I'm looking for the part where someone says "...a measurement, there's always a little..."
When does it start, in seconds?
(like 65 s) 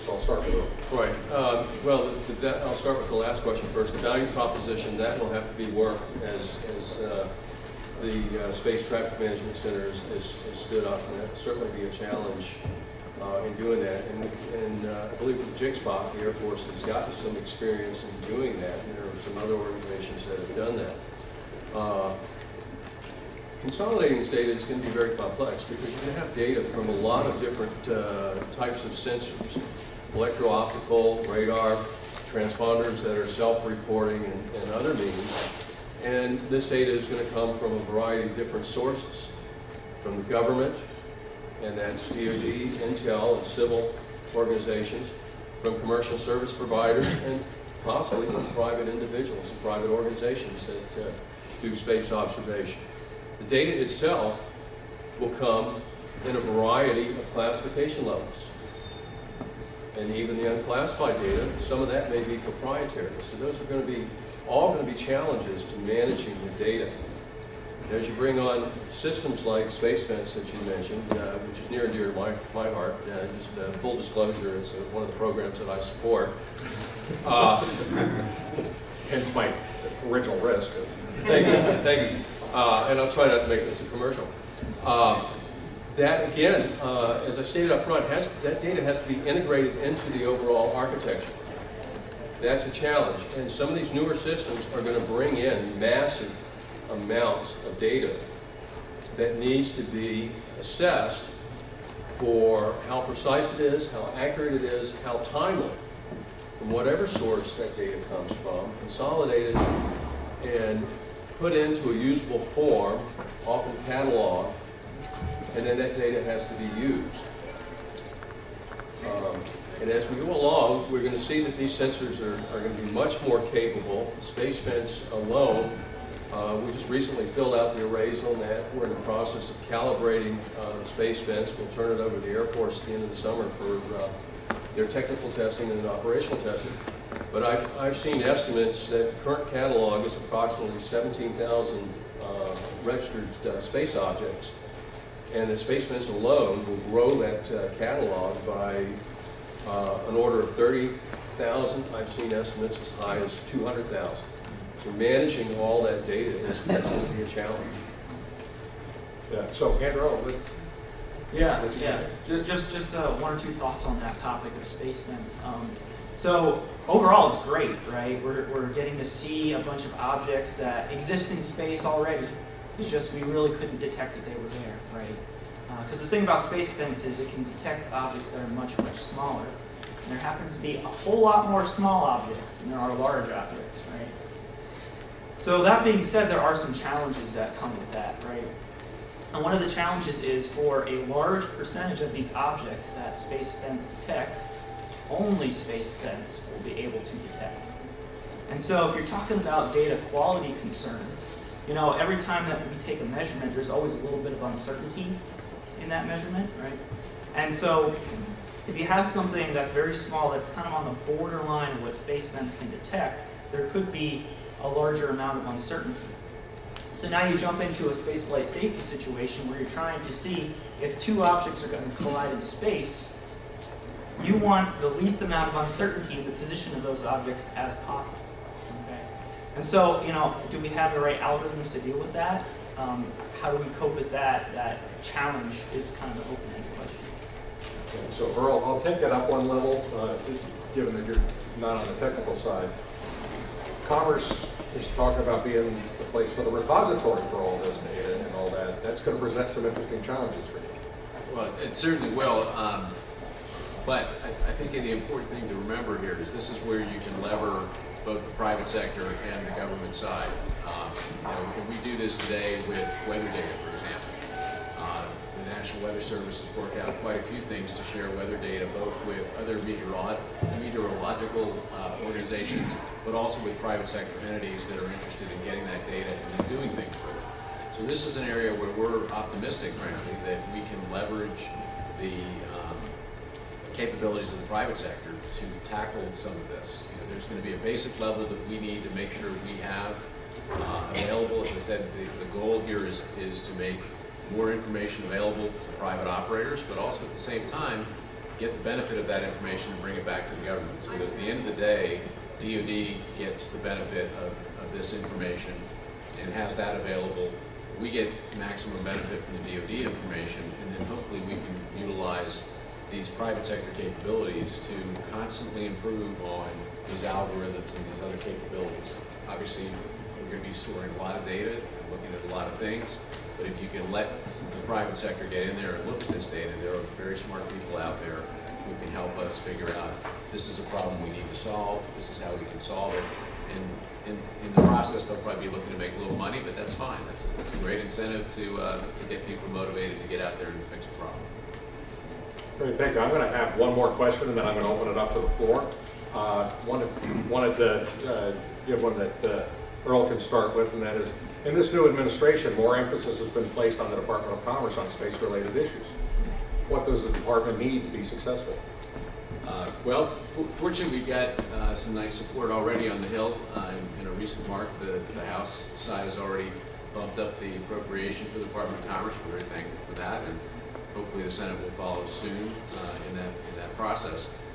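202 s.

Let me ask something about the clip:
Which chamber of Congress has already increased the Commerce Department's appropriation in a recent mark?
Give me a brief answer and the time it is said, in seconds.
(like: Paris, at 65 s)
House, at 365 s.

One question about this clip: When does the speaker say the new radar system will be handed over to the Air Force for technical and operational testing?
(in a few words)
end of the summer.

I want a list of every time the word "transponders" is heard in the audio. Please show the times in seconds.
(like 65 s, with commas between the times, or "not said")
32 s.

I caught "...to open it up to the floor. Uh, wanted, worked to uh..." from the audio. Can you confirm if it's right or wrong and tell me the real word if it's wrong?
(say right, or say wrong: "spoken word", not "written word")
wrong: "wanted", not "worked".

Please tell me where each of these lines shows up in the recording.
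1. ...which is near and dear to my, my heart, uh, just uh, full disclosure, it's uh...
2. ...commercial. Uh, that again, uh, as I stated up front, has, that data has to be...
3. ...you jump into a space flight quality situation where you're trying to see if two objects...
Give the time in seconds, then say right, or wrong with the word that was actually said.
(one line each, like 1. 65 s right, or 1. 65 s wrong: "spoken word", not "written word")
1. 71 s right
2. 83 s right
3. 217 s wrong: "safety", not "quality".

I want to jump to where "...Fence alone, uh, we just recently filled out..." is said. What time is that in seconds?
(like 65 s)
124 s.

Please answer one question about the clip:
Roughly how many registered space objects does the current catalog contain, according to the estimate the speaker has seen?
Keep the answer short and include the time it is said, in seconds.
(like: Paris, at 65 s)
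17,000, at 140 s.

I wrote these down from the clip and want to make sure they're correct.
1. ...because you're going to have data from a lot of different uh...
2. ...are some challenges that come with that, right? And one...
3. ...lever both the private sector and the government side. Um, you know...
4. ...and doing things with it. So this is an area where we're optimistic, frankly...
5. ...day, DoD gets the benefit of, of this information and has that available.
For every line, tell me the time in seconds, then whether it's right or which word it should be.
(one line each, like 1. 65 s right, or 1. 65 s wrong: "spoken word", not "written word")
1. 25 s right
2. 186 s right
3. 257 s right
4. 276 s right
5. 301 s right.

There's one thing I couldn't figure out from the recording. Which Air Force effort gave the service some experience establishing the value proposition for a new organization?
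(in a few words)
Jigsaw.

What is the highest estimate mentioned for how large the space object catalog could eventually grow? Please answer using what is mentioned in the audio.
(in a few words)
200,000.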